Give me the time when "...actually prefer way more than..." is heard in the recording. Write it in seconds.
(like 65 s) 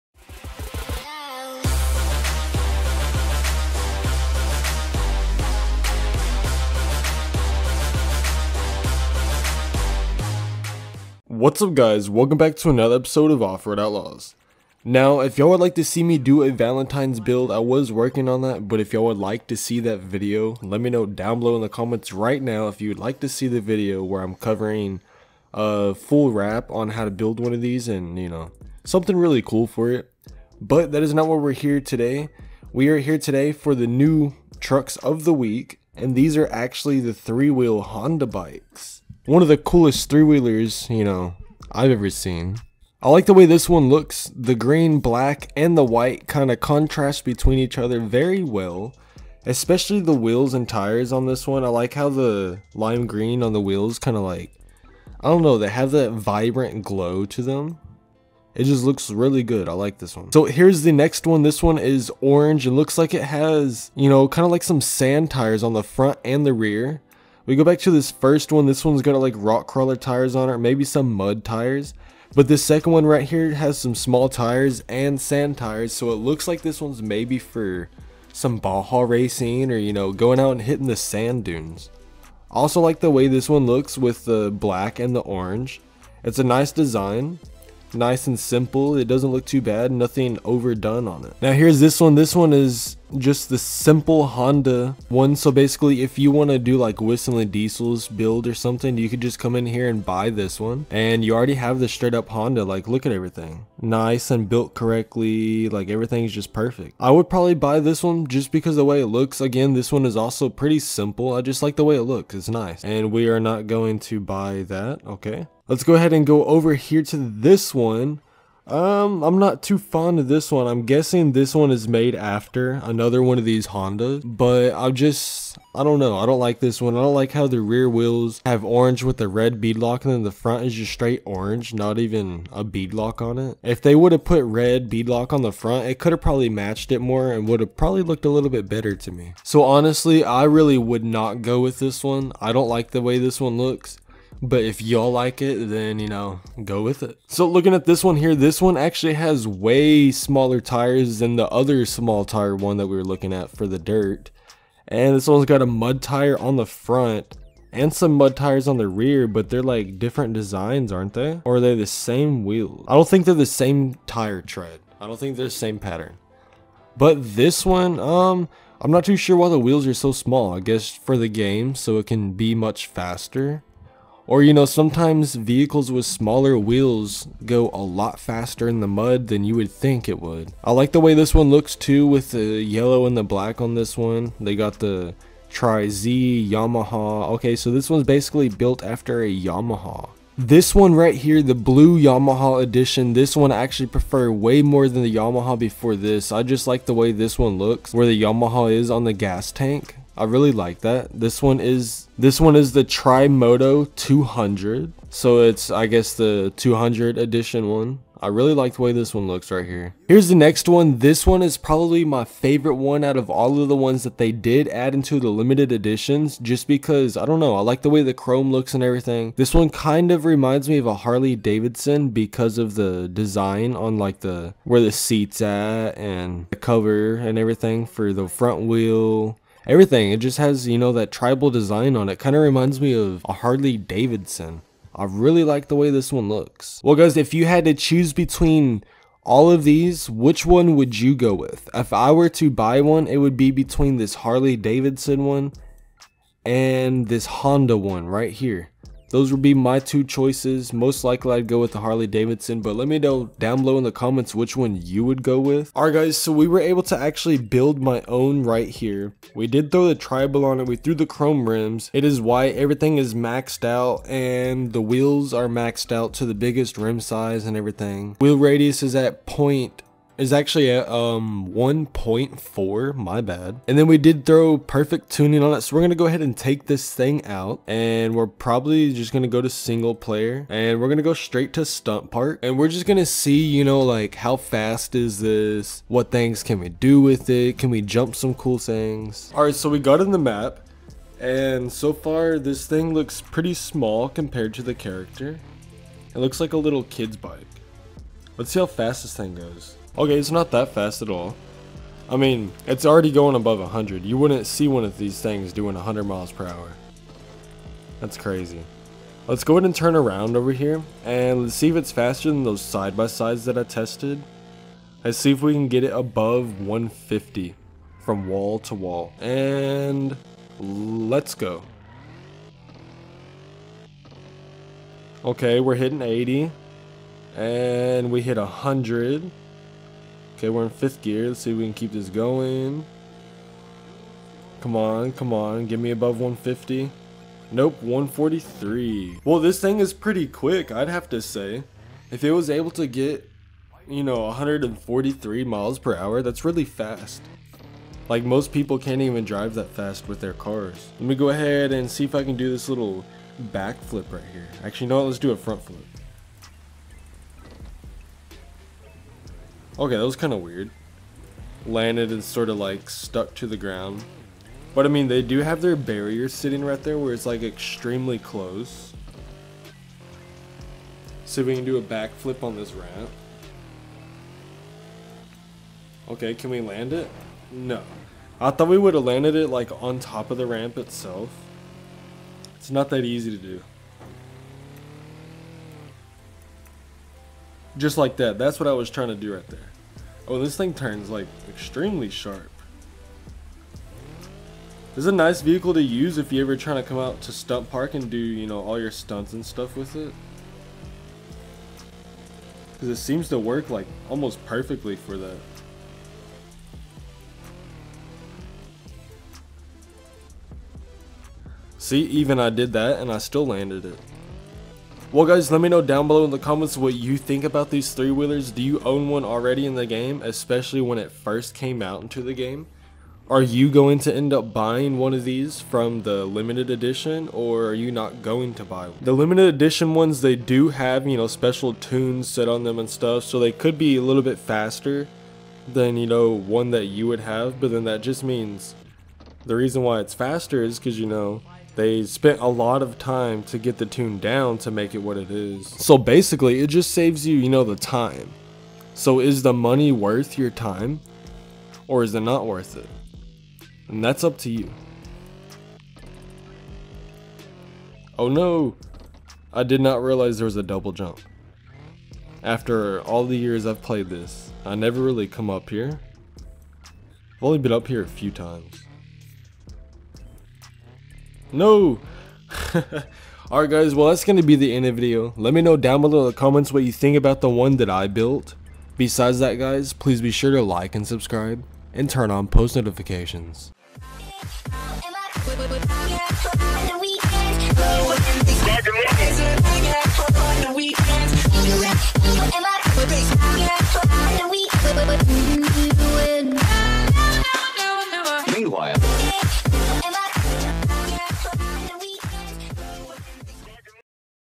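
193 s.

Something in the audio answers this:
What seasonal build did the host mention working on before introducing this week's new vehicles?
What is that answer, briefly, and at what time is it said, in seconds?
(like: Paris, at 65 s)
Valentine's build, at 16 s.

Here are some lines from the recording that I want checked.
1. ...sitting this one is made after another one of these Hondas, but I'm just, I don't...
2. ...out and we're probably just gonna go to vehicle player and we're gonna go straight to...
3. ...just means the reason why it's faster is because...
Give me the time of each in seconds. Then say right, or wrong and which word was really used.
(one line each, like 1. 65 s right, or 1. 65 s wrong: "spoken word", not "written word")
1. 120 s wrong: "guessing", not "sitting"
2. 277 s wrong: "single", not "vehicle"
3. 438 s right.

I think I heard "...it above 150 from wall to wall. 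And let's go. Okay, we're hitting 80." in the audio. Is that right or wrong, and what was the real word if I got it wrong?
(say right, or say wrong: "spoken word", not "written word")
right.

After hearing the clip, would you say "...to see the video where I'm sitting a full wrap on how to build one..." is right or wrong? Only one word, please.
wrong.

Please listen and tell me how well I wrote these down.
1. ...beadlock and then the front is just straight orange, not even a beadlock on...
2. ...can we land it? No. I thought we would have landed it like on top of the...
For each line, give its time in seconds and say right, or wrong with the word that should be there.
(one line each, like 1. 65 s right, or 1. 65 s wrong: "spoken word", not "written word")
1. 129 s right
2. 376 s right.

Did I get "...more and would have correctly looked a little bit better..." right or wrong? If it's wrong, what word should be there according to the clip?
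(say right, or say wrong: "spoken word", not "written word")
wrong: "probably", not "correctly".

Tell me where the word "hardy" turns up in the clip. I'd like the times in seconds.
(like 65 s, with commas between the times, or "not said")
not said.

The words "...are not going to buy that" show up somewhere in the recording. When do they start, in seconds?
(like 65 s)
113 s.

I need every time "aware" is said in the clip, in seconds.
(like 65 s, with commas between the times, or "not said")
not said.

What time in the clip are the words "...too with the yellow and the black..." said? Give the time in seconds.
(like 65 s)
181 s.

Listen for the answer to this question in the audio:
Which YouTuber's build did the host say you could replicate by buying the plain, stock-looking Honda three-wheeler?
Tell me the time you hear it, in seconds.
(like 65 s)
96 s.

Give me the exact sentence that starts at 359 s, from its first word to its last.
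Okay, that was kind of weird.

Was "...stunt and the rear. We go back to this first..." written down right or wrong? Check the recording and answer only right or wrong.
wrong.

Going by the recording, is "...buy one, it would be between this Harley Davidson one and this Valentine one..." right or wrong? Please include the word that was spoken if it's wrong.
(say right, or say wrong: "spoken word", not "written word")
wrong: "Honda", not "Valentine".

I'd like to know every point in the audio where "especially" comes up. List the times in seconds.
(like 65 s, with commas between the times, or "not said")
49 s, 420 s.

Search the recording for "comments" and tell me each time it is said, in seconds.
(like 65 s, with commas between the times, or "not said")
21 s, 253 s, 416 s, 476 s.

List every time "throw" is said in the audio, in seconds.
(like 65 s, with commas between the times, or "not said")
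259 s, 274 s.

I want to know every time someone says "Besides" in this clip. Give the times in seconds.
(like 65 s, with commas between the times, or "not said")
478 s.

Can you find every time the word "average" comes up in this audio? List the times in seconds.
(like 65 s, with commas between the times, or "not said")
not said.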